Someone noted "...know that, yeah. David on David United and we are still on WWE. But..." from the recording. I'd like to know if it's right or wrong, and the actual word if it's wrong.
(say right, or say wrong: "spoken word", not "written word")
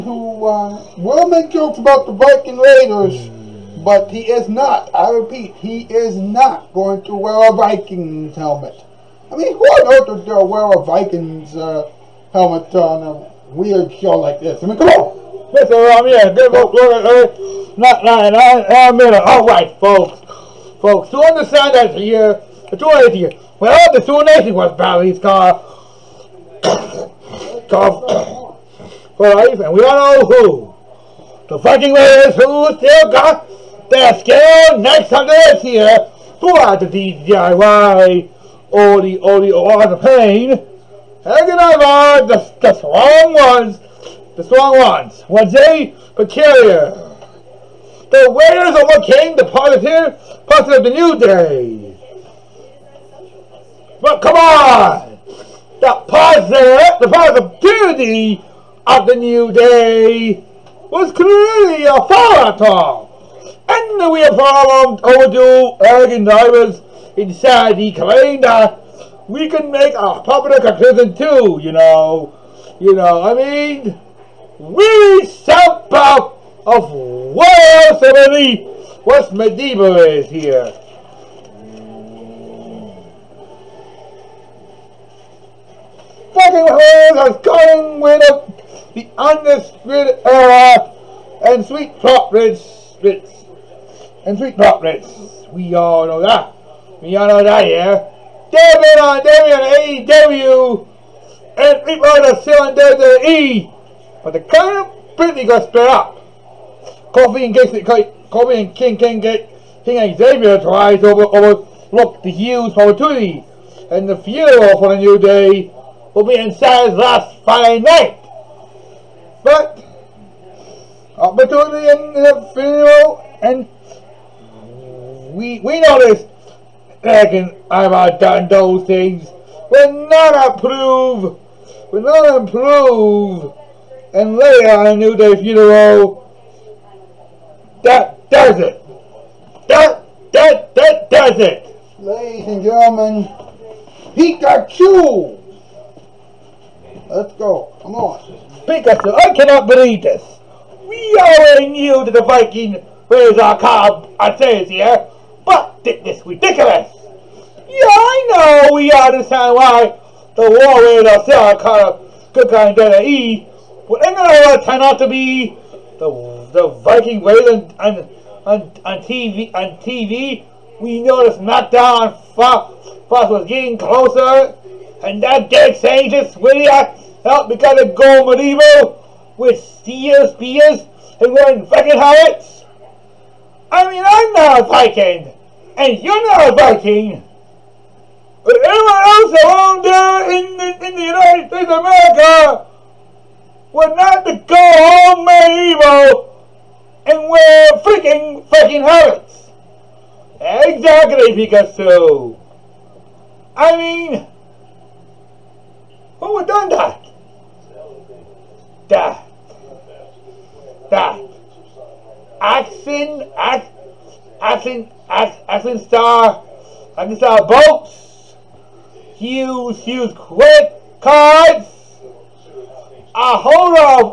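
wrong: "AEW", not "United".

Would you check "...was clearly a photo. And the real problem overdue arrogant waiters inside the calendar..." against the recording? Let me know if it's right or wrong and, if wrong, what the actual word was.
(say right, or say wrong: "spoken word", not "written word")
wrong: "drivers", not "waiters".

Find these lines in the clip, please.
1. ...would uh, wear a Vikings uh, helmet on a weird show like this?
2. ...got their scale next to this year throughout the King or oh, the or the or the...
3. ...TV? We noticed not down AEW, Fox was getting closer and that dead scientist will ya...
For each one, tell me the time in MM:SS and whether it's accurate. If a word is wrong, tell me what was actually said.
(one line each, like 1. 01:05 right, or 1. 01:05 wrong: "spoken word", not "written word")
1. 00:10 right
2. 00:33 wrong: "DIY", not "King"
3. 02:49 wrong: "Fox", not "AEW".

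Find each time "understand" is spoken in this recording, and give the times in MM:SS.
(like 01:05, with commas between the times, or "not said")
00:21, 02:38.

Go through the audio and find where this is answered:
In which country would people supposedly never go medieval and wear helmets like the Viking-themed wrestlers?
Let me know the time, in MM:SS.
03:11.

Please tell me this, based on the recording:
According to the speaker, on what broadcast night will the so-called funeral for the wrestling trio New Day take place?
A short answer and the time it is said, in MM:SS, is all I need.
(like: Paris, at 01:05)
Friday night, at 01:57.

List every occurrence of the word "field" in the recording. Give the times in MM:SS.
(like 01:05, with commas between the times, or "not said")
02:02.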